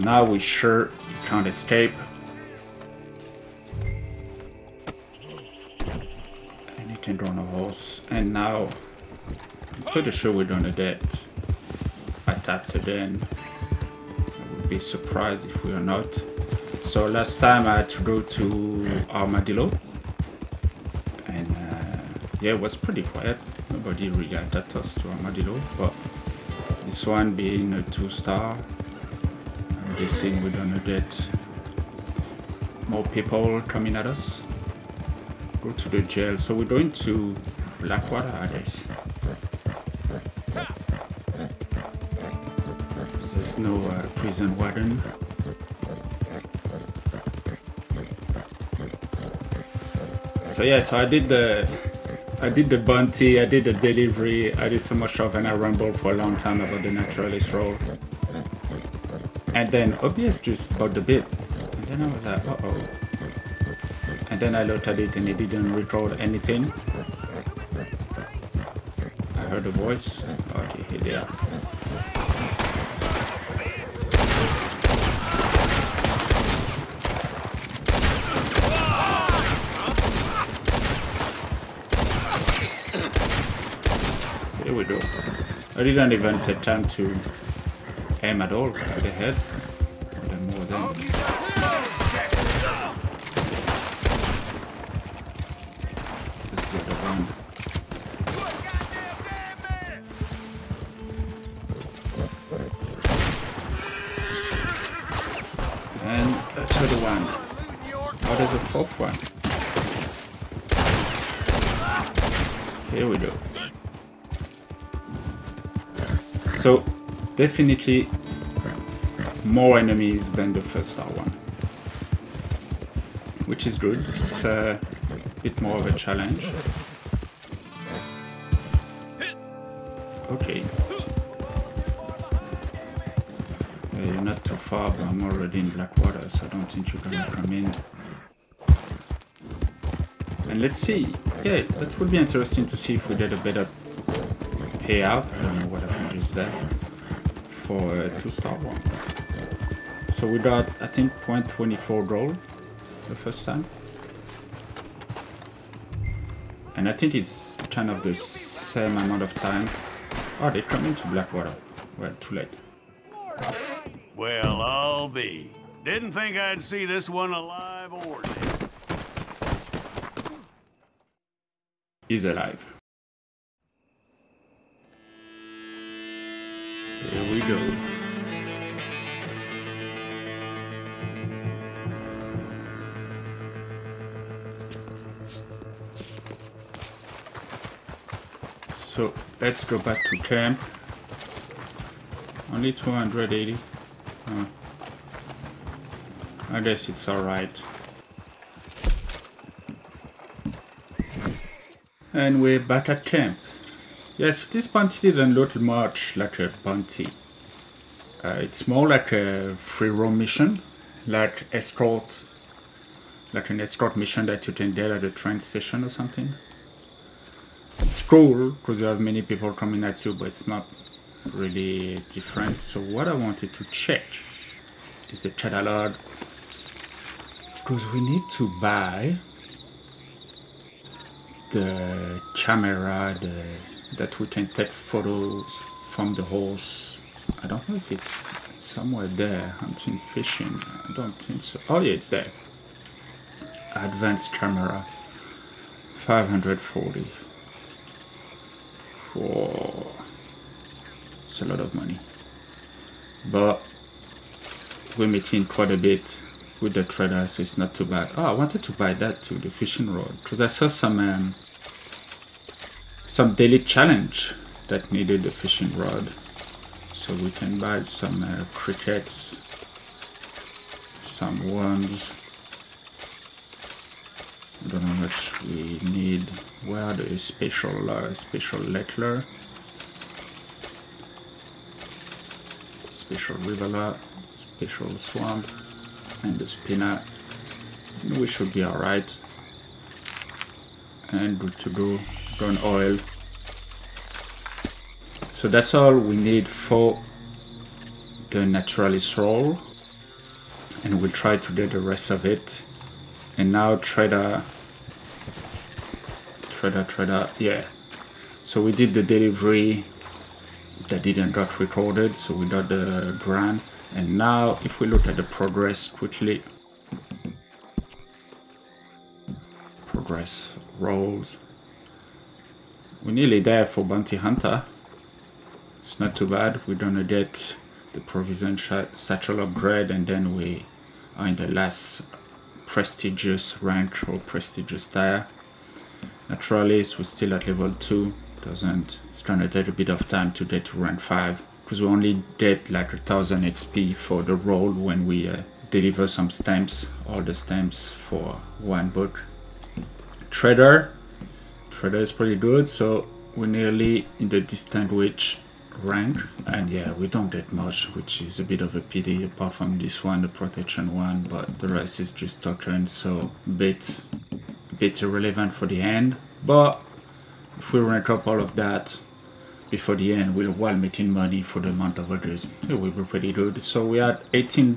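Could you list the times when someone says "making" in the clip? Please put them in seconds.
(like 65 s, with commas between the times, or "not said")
255 s, 370 s.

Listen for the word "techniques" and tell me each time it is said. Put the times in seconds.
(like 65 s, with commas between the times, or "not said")
not said.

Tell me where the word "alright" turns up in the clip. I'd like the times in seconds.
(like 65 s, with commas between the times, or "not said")
197 s, 288 s.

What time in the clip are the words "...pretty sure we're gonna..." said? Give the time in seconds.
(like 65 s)
9 s.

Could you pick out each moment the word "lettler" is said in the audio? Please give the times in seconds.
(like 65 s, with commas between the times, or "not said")
278 s.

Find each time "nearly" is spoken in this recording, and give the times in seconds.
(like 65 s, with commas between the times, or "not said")
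323 s, 353 s.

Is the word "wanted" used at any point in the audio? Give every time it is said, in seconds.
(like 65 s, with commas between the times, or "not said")
223 s, 258 s.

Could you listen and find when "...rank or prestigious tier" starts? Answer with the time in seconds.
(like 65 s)
333 s.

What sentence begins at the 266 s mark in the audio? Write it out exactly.
So we can buy some uh, crickets, some worms.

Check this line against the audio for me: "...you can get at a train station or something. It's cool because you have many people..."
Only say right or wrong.
right.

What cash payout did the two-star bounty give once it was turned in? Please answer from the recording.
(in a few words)
280.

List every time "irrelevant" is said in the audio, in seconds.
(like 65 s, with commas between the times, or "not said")
365 s.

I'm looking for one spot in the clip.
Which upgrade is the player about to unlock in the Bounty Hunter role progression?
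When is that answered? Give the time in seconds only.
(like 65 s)
328 s.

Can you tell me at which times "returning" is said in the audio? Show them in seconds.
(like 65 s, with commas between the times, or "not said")
not said.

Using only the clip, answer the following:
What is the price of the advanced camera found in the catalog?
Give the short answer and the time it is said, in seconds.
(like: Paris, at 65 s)
540, at 245 s.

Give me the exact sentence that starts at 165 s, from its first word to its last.
Didn't think I'd see this one alive or dead.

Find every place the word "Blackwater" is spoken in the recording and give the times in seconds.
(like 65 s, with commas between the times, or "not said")
37 s, 135 s, 161 s.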